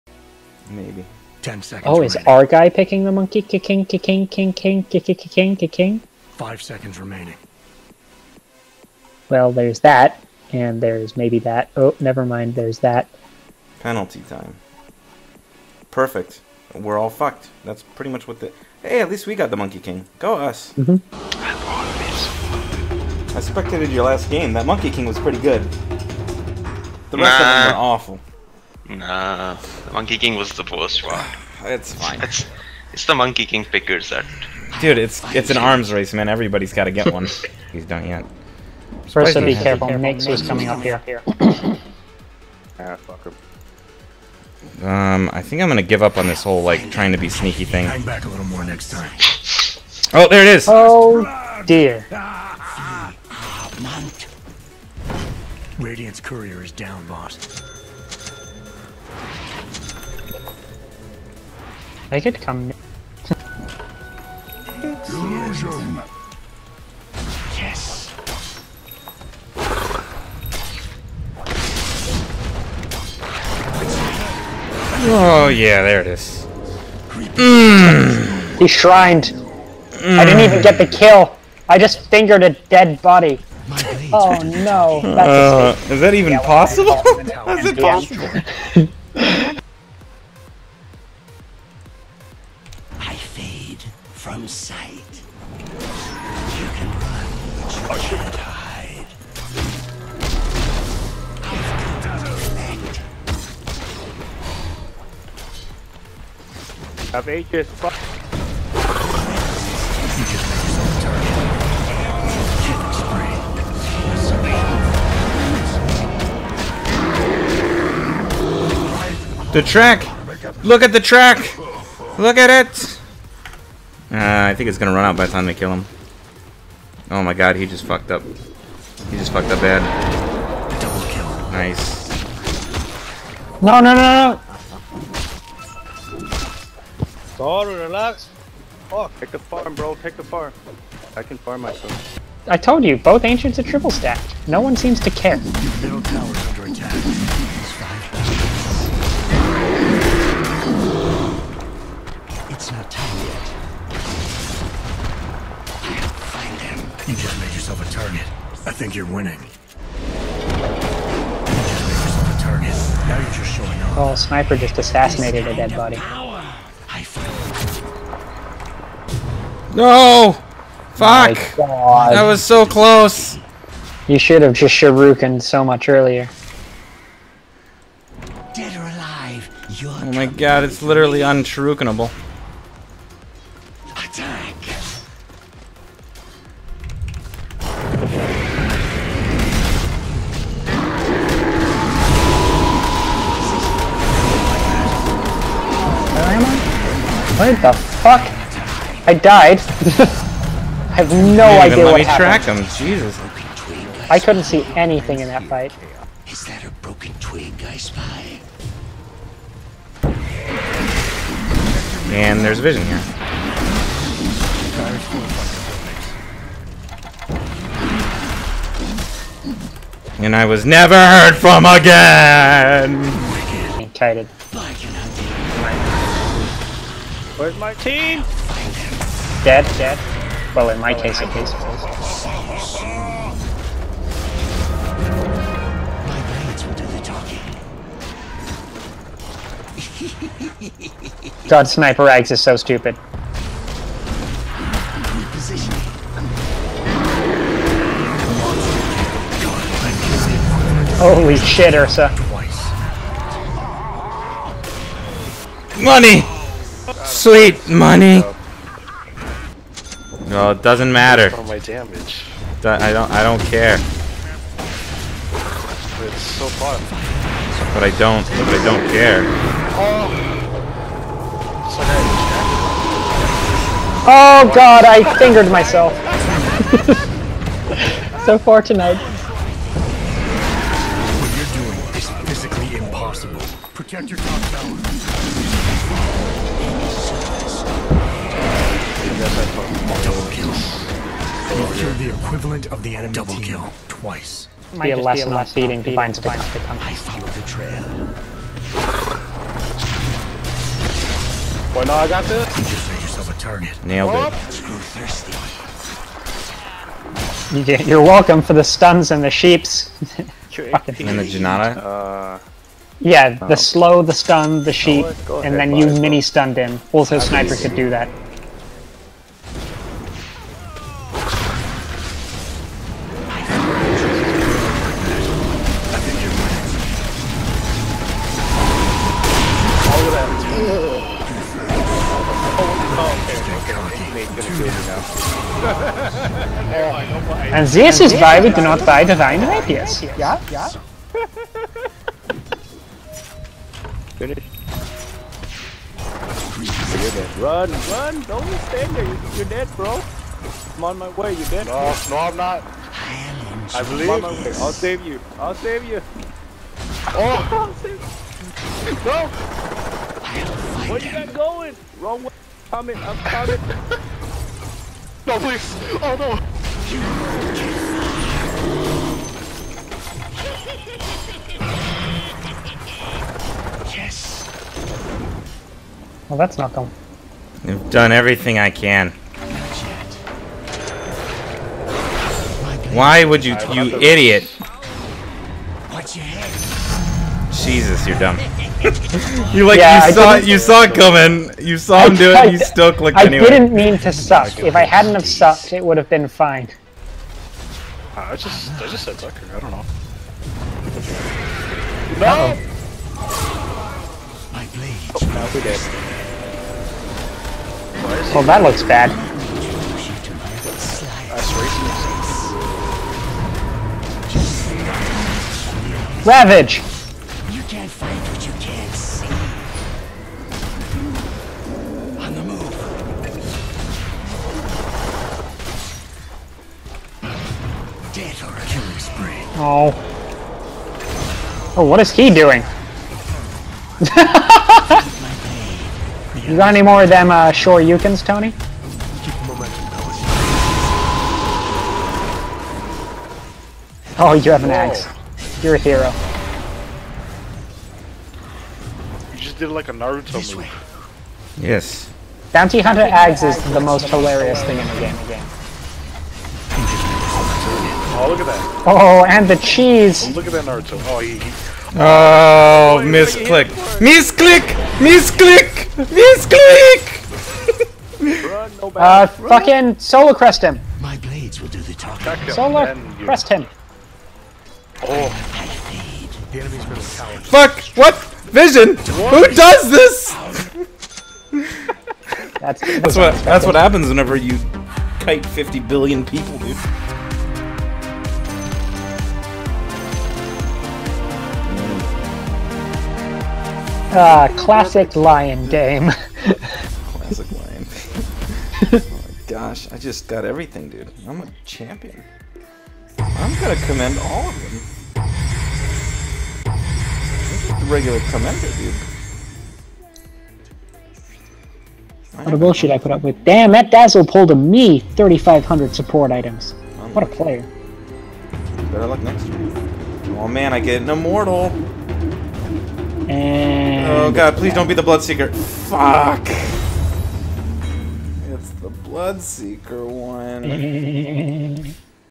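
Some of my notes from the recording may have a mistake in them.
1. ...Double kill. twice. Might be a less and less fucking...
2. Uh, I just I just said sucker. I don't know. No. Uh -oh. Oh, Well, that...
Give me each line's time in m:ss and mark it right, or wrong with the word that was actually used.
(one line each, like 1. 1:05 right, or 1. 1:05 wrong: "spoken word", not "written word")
1. 4:53 wrong: "feeding", not "fucking"
2. 6:38 right.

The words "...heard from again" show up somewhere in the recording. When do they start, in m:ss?
3:40.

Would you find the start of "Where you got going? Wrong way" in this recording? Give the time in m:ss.
6:00.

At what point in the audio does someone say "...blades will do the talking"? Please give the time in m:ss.
7:51.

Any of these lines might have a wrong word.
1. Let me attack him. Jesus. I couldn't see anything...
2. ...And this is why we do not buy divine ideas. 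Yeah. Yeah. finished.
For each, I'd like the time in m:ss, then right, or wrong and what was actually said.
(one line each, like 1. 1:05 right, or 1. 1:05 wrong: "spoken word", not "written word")
1. 3:22 wrong: "track", not "attack"
2. 5:37 right.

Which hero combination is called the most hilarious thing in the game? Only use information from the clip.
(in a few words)
Bounty Hunter Axe.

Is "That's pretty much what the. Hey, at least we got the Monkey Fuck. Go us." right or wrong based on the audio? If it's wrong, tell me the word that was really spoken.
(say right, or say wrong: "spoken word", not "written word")
wrong: "King", not "Fuck".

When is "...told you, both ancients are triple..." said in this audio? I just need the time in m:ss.
2:22.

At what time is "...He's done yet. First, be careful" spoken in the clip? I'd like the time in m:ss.
0:37.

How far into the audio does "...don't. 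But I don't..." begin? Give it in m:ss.
4:27.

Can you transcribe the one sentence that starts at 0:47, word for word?
Hang back a little more next time.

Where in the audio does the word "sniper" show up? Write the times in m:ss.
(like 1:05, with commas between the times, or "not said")
2:44, 4:01, 5:17.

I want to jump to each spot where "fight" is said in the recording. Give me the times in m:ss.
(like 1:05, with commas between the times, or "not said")
3:25.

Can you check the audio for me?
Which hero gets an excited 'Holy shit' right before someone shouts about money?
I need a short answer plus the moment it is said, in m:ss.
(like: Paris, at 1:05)
Ursa, at 4:11.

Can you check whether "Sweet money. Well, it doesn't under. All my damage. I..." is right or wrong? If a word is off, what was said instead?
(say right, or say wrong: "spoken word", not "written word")
wrong: "matter", not "under".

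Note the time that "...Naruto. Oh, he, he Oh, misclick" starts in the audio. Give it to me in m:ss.
7:40.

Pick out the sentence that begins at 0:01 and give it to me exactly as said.
Oh, is our guy picking the monkey?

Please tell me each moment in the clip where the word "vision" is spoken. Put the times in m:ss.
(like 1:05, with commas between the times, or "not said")
3:32, 7:58.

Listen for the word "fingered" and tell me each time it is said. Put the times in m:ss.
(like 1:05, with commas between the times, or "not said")
1:22, 4:35.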